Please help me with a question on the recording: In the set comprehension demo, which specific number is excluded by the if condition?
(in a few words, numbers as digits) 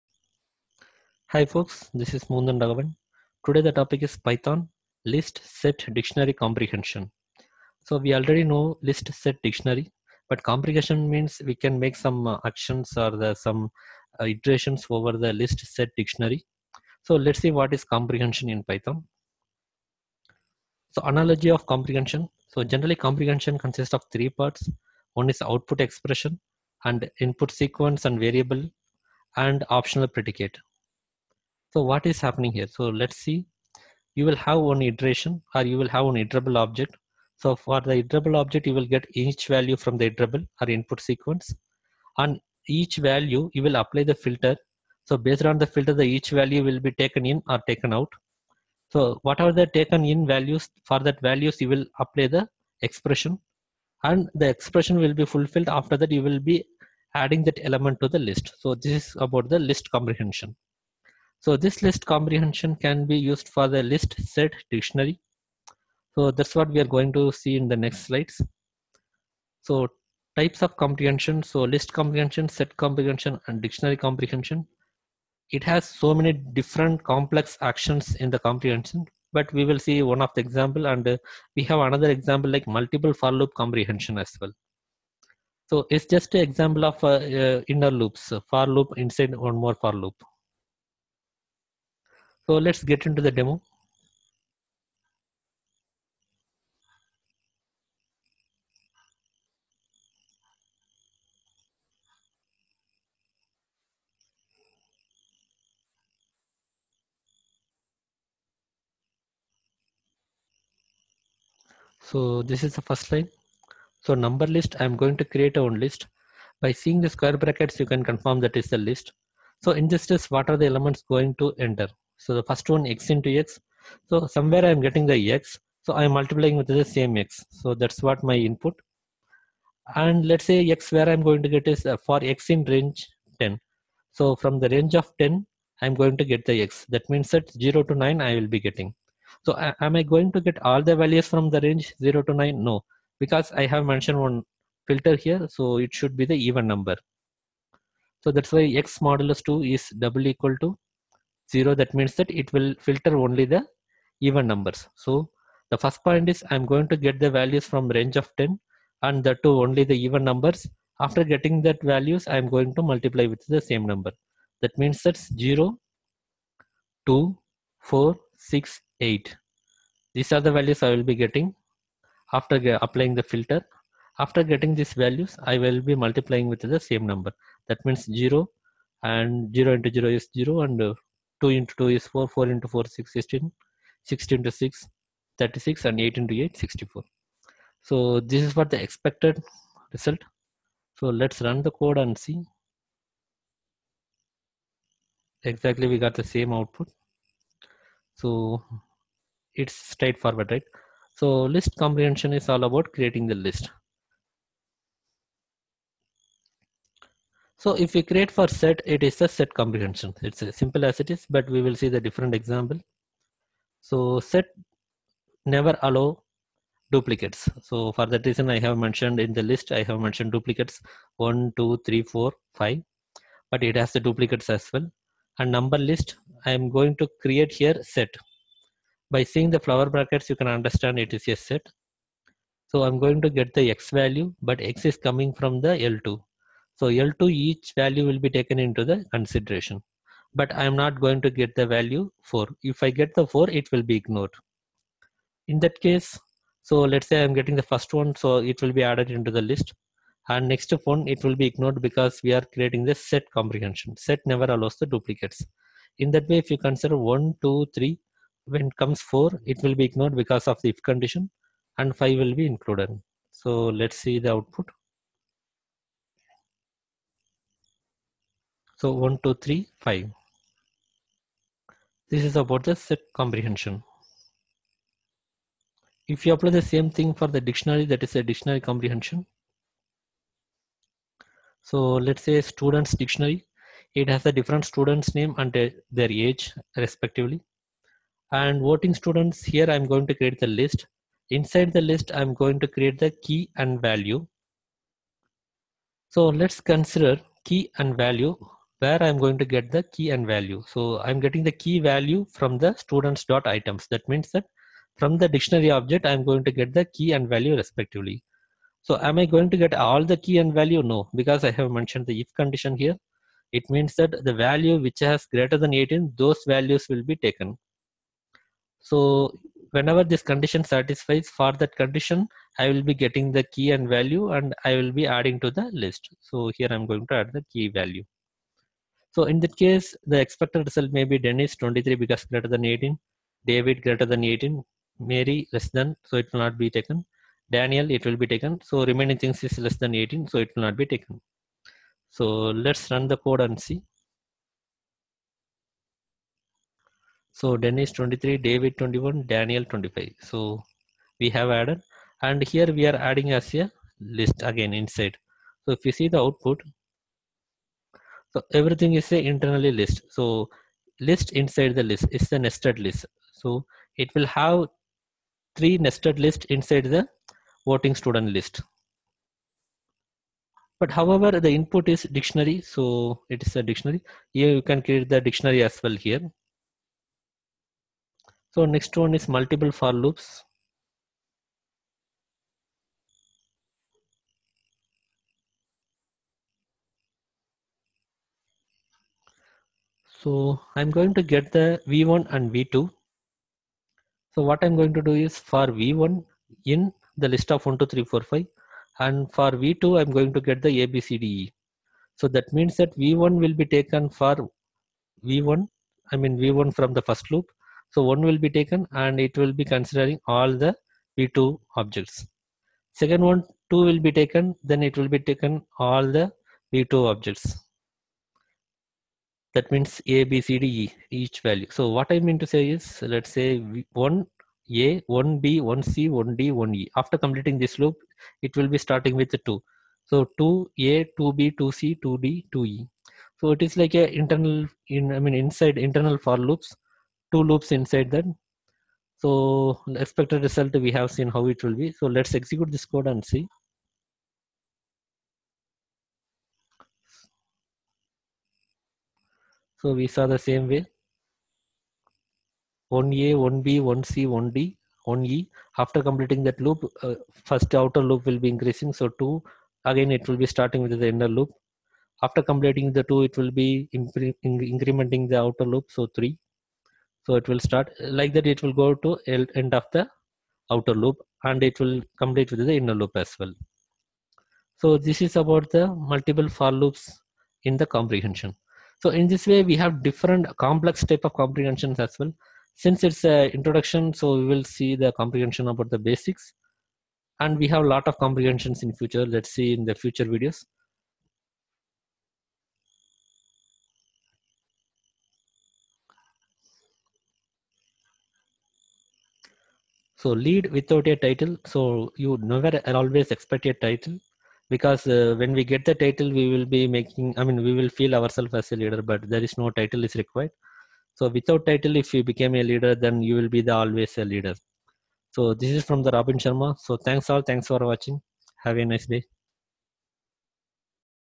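4.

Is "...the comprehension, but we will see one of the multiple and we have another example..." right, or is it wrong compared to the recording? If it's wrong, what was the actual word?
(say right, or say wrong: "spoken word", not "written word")
wrong: "example", not "multiple".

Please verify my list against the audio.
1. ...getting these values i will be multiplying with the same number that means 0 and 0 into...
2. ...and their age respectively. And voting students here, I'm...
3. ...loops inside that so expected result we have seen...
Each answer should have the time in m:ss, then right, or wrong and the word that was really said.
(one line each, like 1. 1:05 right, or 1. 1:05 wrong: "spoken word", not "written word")
1. 2:54 right
2. 4:45 right
3. 7:17 right.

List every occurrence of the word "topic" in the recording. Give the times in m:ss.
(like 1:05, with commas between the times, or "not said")
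0:03.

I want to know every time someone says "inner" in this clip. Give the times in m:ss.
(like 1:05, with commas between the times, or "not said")
1:27, 7:41, 7:52.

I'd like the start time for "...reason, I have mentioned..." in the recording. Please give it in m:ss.
3:38.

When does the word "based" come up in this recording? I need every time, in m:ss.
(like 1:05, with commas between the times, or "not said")
0:45.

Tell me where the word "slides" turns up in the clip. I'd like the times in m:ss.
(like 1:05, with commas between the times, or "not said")
1:08.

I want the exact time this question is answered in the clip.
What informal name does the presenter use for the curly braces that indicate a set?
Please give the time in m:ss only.
3:49.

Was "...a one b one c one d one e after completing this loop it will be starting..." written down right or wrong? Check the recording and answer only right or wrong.
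right.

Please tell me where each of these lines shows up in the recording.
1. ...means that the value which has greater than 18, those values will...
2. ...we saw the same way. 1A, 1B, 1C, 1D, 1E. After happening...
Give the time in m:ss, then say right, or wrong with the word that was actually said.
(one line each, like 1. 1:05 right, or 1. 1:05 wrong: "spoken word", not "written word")
1. 5:13 right
2. 7:29 wrong: "completing", not "happening".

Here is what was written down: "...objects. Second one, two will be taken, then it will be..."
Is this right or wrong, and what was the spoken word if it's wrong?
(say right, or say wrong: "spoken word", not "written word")
right.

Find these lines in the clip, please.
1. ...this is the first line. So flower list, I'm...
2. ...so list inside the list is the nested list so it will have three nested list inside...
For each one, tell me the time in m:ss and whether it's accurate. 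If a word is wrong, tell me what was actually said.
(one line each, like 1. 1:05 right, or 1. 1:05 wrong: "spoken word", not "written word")
1. 1:52 wrong: "number", not "flower"
2. 6:00 right.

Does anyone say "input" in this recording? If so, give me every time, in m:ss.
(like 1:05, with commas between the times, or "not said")
0:27, 0:40, 2:08, 6:11.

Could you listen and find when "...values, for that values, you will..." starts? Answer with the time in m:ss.
0:50.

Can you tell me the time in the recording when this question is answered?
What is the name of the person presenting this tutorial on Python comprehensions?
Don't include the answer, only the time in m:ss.
0:02.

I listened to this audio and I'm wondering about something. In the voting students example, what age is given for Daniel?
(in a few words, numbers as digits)
25.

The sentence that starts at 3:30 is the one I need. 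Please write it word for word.
It's as simple as it is, but we will see the different example.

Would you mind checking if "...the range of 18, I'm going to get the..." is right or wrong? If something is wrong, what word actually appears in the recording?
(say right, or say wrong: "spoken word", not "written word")
wrong: "10", not "18".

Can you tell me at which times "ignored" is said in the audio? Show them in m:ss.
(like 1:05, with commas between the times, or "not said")
4:03, 4:11, 4:19.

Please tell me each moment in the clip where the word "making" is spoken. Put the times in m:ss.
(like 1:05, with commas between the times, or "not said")
8:26.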